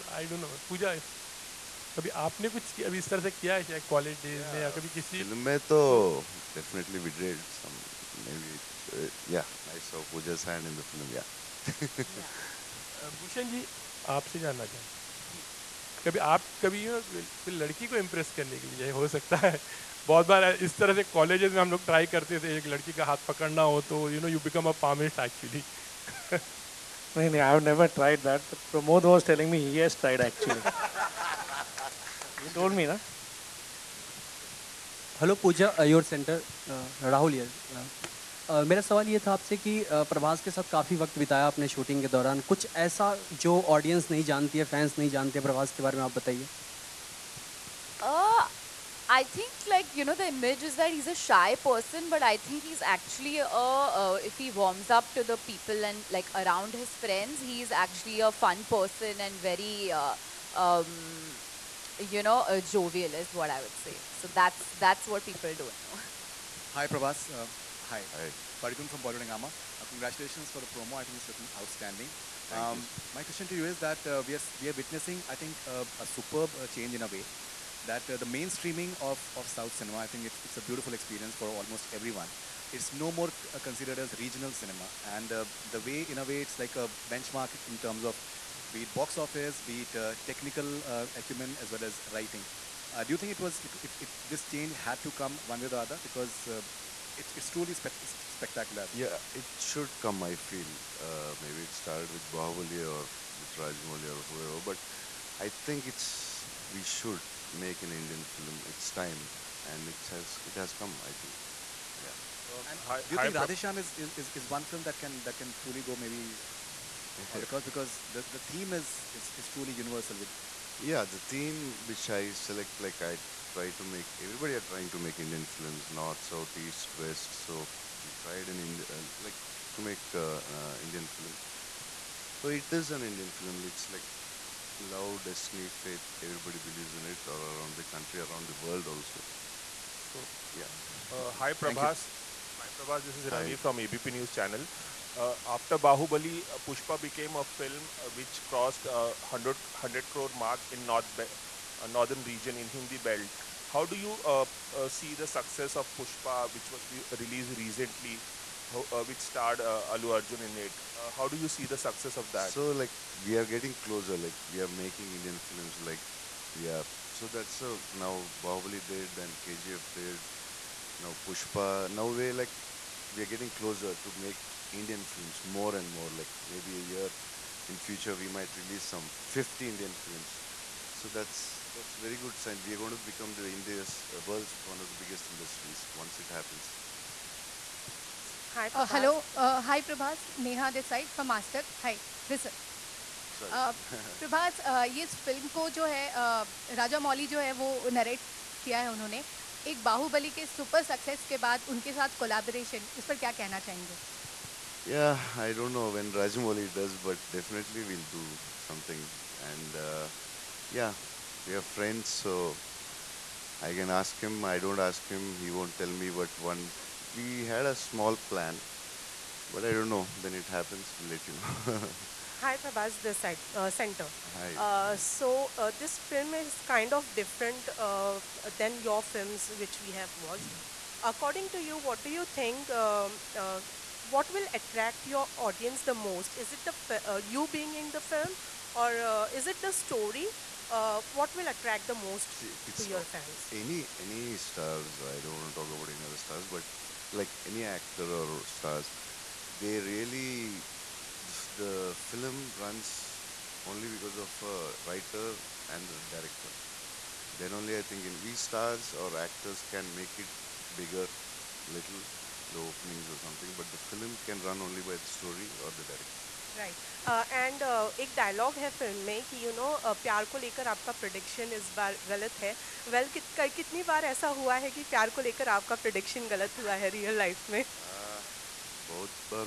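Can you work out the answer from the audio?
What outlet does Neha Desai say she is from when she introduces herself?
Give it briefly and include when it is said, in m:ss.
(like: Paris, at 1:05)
Mastec, at 3:11.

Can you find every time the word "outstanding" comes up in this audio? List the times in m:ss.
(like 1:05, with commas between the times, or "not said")
1:11.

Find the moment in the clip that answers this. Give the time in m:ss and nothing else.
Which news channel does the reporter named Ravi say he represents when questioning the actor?
2:23.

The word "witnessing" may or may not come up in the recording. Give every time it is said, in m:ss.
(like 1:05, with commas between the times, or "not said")
1:14.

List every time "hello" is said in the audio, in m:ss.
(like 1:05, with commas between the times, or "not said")
3:08.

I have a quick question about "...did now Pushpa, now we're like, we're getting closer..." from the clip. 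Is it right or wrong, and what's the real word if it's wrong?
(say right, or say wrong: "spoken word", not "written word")
right.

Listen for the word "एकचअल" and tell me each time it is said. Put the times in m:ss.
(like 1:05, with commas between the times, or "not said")
0:25, 0:30, 0:52, 0:57.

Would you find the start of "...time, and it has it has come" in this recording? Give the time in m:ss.
1:48.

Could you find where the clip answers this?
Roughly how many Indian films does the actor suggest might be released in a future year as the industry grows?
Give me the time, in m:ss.
2:59.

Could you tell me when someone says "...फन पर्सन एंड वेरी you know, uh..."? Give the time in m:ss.
0:58.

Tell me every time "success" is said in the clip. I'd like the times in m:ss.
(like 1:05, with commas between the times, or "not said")
2:35, 2:41.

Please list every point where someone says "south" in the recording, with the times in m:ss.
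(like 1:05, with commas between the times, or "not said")
1:19, 2:06.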